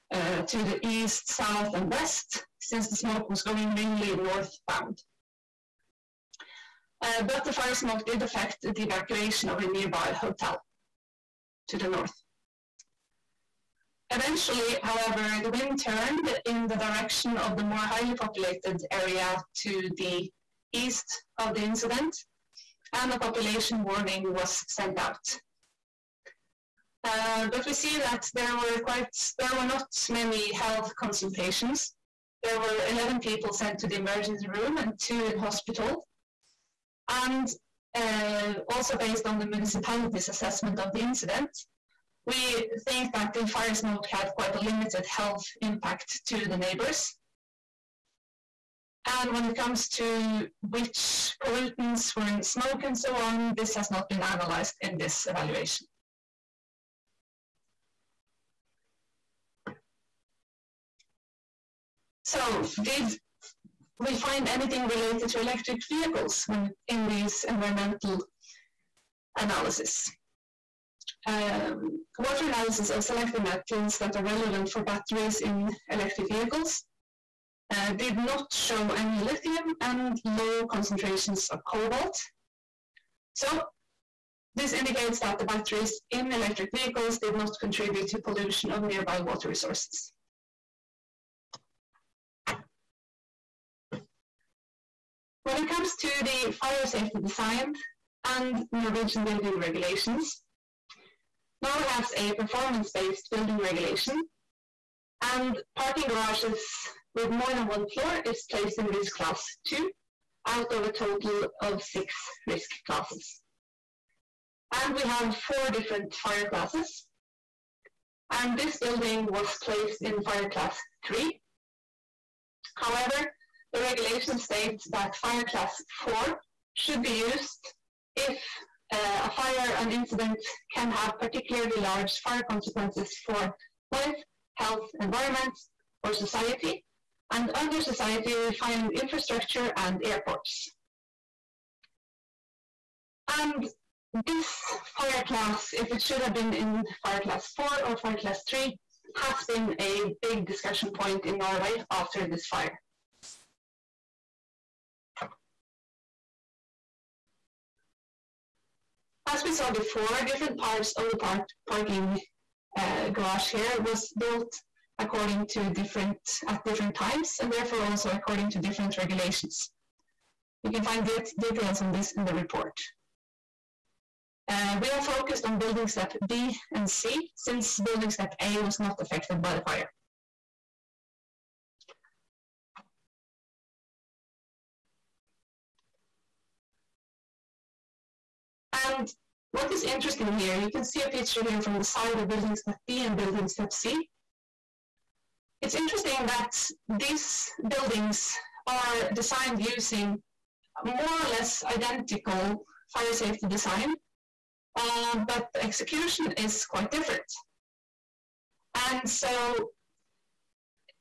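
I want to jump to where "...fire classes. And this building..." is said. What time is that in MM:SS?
01:56.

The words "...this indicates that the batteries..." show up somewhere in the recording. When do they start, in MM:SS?
01:24.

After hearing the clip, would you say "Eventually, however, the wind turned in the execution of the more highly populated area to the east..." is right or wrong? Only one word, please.
wrong.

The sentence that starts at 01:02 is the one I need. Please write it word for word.
So did we find anything related to electric vehicles when in these environmental analysis.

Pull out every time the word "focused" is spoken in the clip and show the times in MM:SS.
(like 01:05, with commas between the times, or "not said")
02:55.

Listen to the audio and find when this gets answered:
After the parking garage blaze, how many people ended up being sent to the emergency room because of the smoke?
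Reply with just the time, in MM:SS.
00:32.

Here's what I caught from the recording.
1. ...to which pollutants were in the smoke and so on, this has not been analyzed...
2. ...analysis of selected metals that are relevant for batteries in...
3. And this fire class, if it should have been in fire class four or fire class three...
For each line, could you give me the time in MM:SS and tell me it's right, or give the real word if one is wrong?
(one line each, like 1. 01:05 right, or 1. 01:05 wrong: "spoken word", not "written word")
1. 00:49 right
2. 01:12 right
3. 02:23 right.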